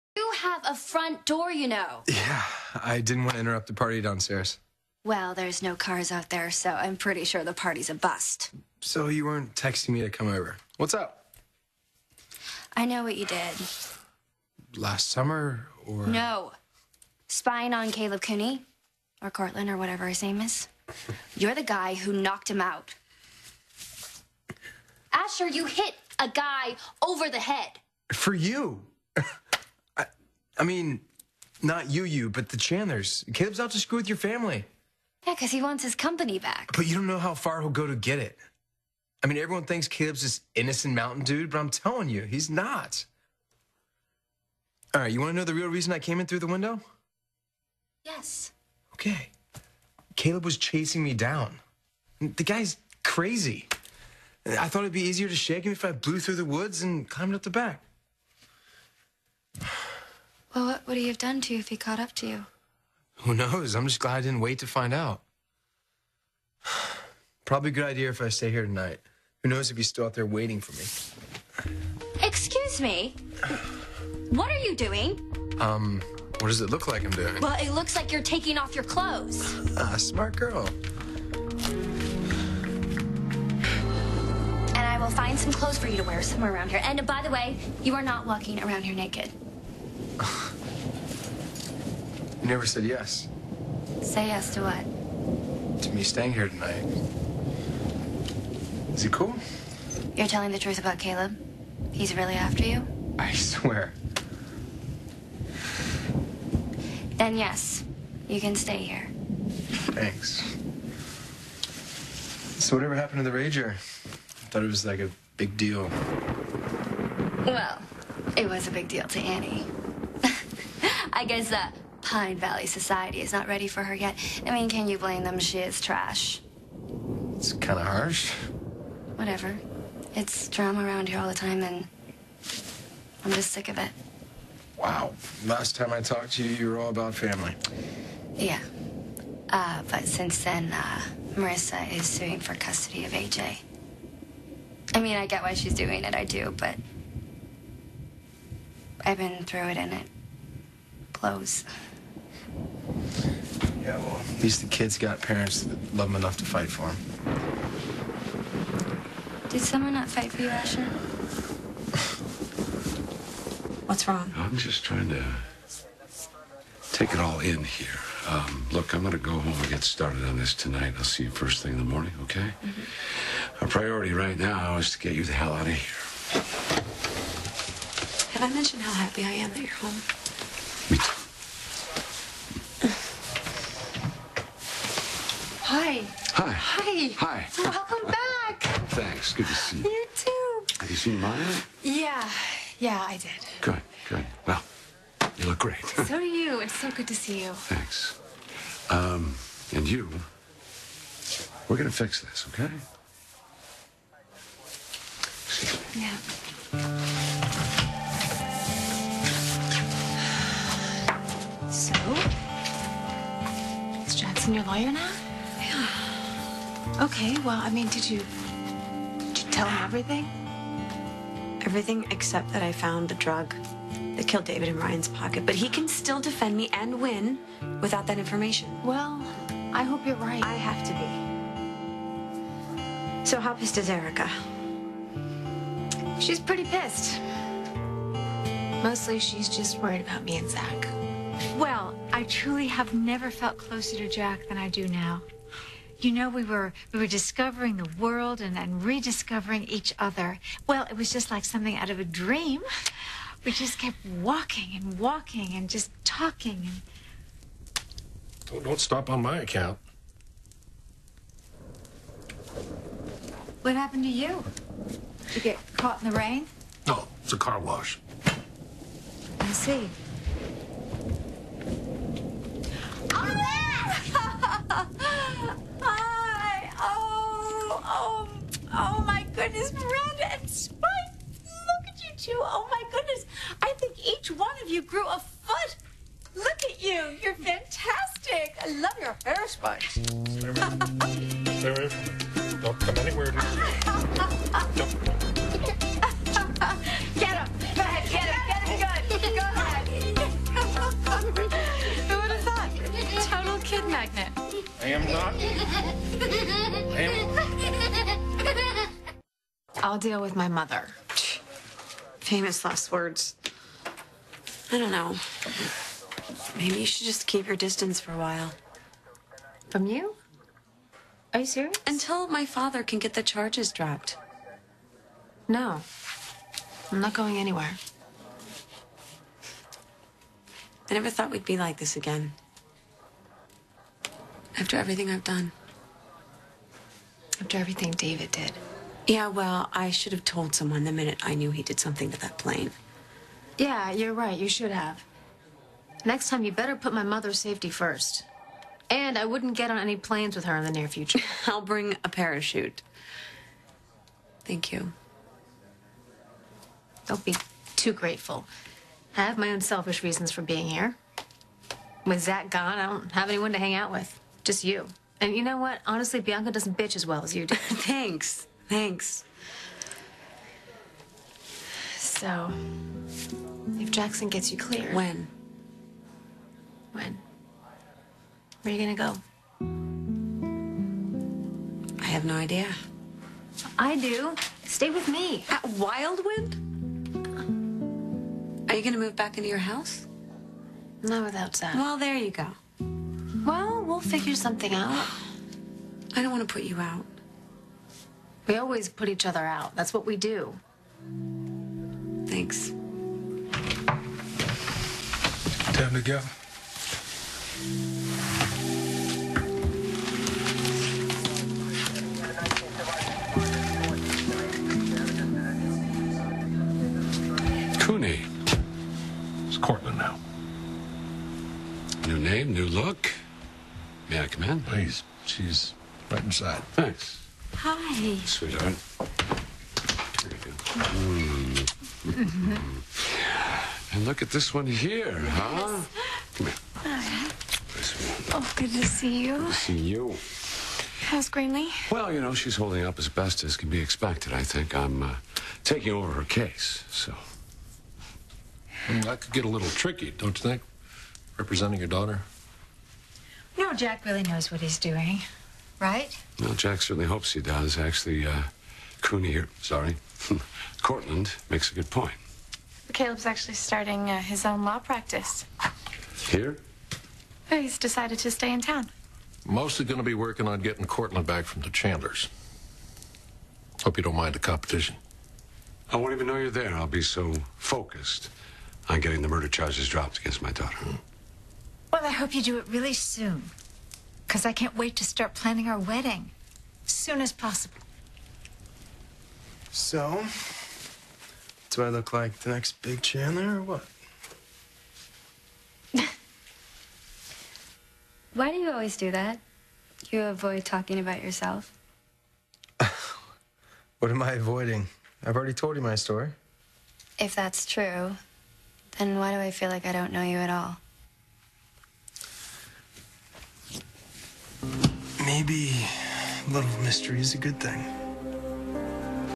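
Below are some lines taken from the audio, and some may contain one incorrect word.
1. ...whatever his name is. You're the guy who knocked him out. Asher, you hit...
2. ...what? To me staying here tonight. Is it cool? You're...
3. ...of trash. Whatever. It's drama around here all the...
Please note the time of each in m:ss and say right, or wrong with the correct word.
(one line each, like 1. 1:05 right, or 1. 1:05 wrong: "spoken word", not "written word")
1. 0:19 right
2. 1:34 right
3. 2:07 wrong: "harsh", not "trash".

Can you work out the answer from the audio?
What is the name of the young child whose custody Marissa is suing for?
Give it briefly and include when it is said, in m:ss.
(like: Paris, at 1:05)
AJ, at 2:23.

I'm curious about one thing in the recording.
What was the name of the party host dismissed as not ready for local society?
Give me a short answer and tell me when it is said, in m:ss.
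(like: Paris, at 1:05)
Annie, at 1:59.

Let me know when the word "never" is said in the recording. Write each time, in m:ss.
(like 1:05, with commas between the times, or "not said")
1:32, 4:02, 5:30.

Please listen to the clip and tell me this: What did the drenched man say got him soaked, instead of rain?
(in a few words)
a car wash.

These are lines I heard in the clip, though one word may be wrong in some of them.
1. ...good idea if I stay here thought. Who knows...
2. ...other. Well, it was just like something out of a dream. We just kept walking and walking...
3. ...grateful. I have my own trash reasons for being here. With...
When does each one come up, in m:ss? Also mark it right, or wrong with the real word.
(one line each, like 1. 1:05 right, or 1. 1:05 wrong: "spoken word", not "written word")
1. 1:07 wrong: "tonight", not "thought"
2. 4:09 right
3. 5:57 wrong: "selfish", not "trash".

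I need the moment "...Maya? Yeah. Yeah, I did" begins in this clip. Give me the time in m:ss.
3:11.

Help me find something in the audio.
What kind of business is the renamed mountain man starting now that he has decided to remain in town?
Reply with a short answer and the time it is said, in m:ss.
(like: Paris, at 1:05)
law practice, at 7:44.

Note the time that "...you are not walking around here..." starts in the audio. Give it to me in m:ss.
1:27.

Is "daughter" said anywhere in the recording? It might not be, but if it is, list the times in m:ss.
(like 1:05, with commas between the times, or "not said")
7:31, 8:00.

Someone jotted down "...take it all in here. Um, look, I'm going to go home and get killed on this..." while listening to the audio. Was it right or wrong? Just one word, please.
wrong.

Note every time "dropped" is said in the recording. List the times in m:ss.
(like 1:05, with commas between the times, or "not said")
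5:23, 7:59.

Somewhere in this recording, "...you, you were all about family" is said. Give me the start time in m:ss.
2:16.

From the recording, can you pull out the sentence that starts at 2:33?
Yeah, well, at least the kids got parents that love them enough to fight for them.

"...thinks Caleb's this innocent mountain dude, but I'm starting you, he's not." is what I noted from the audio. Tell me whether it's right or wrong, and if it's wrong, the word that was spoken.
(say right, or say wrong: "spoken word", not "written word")
wrong: "telling", not "starting".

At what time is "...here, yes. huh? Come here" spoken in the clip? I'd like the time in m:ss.
7:14.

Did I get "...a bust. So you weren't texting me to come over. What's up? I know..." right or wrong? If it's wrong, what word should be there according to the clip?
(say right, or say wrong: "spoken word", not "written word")
right.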